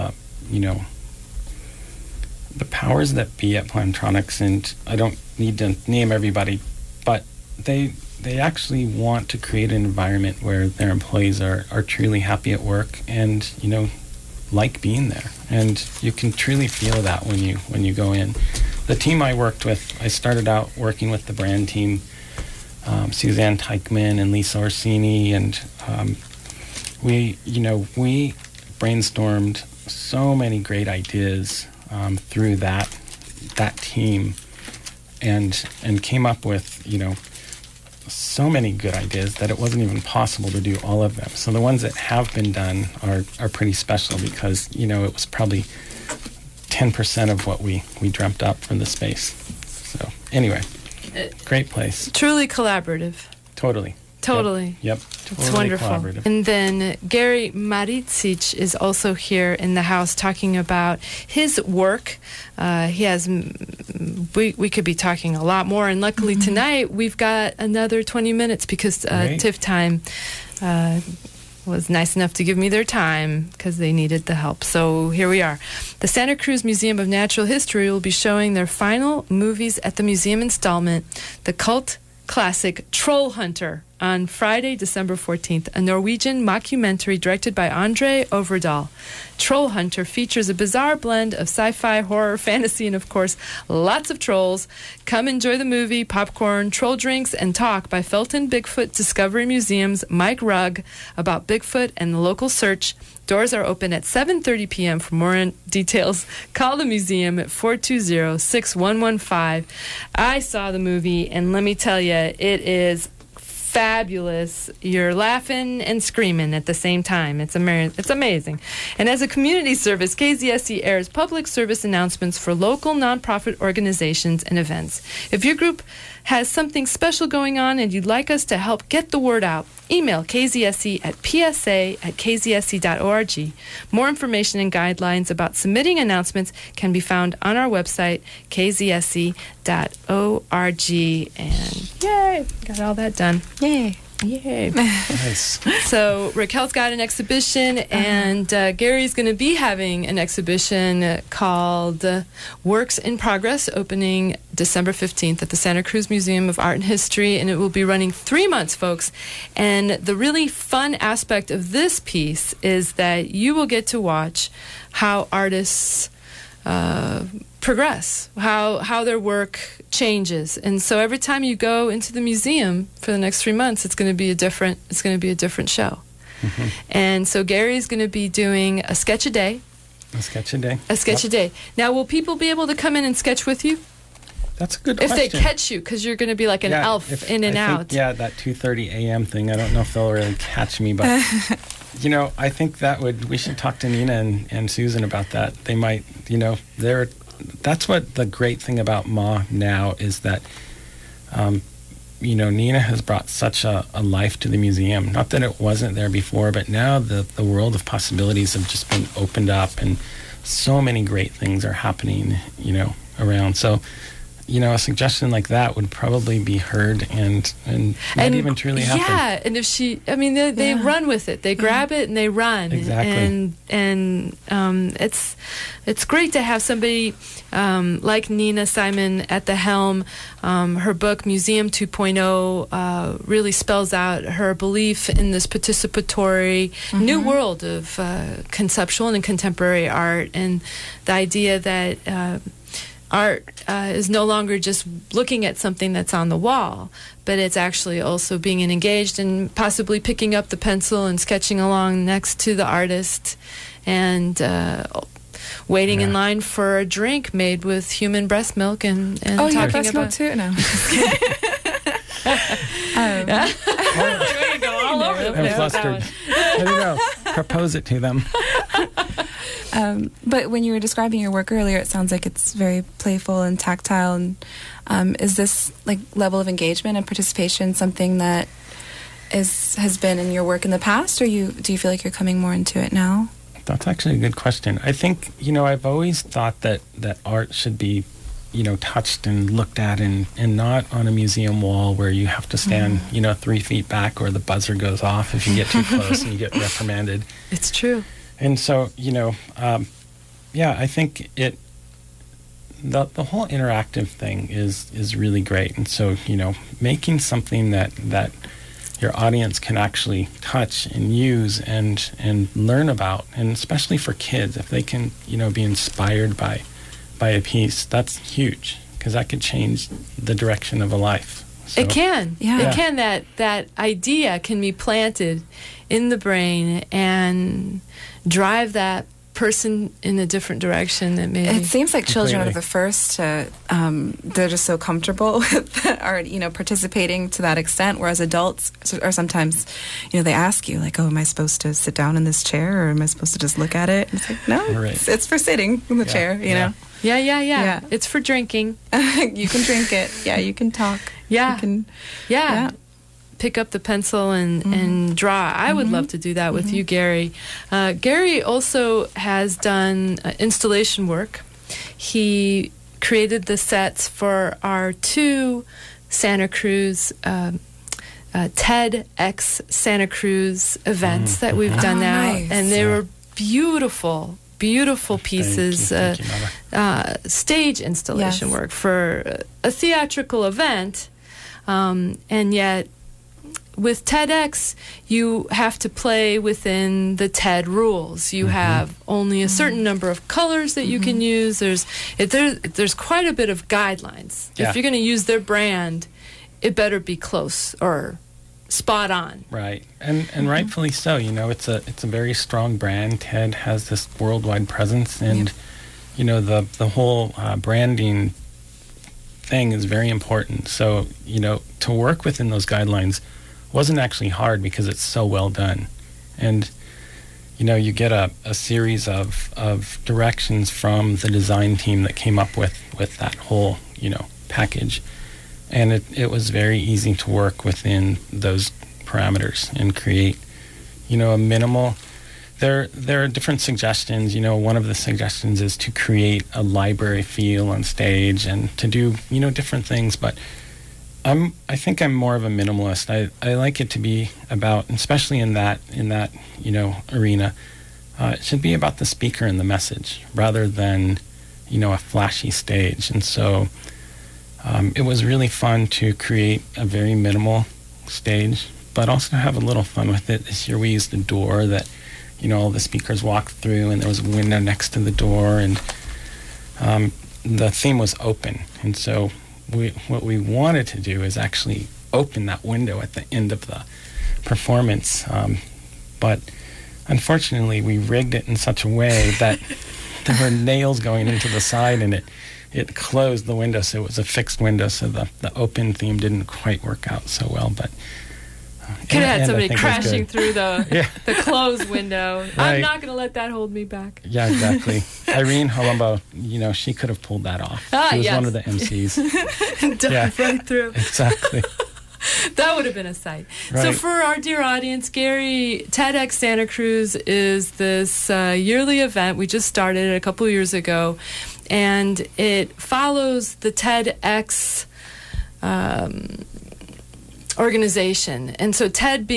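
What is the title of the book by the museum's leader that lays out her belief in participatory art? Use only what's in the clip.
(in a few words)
Museum 2.0.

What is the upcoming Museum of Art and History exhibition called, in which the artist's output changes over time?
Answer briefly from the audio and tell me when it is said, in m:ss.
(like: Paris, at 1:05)
Works in Progress, at 2:32.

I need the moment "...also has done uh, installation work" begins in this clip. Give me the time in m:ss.
5:58.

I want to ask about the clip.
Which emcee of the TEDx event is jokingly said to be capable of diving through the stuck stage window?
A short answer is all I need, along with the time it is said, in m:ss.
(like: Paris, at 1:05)
Irene Holumbo, at 8:15.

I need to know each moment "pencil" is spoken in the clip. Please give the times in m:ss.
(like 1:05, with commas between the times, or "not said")
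4:10, 5:53.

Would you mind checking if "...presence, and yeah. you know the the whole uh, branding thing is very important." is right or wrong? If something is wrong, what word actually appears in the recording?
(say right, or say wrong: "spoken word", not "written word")
right.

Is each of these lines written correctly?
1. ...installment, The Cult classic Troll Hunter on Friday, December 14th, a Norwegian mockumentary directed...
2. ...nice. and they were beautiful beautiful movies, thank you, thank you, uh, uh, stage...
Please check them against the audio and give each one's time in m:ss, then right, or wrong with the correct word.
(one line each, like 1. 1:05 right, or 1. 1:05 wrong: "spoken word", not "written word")
1. 1:20 right
2. 6:12 wrong: "pieces", not "movies".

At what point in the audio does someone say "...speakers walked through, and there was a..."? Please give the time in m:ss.
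7:42.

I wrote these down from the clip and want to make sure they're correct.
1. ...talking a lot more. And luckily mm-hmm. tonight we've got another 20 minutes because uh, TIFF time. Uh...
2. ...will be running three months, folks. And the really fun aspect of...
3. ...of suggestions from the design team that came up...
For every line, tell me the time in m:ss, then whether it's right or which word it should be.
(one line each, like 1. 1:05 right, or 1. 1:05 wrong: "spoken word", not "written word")
1. 1:04 right
2. 2:37 right
3. 6:59 wrong: "directions", not "suggestions".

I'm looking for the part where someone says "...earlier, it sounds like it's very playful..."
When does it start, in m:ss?
4:31.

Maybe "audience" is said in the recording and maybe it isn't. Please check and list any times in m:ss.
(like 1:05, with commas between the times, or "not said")
5:09, 8:24.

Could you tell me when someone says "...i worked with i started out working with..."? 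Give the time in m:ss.
0:19.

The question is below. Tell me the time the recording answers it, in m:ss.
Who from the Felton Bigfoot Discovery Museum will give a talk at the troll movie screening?
1:40.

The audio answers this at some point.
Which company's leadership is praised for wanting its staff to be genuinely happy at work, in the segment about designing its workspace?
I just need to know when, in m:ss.
0:03.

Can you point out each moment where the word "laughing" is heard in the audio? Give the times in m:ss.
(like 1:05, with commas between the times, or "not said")
1:55.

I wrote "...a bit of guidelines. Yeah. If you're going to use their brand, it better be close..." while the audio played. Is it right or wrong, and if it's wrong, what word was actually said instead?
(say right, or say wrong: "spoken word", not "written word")
right.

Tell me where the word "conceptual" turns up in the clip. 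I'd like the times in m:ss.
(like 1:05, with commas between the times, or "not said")
3:58.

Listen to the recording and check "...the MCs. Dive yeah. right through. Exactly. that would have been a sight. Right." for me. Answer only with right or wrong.
right.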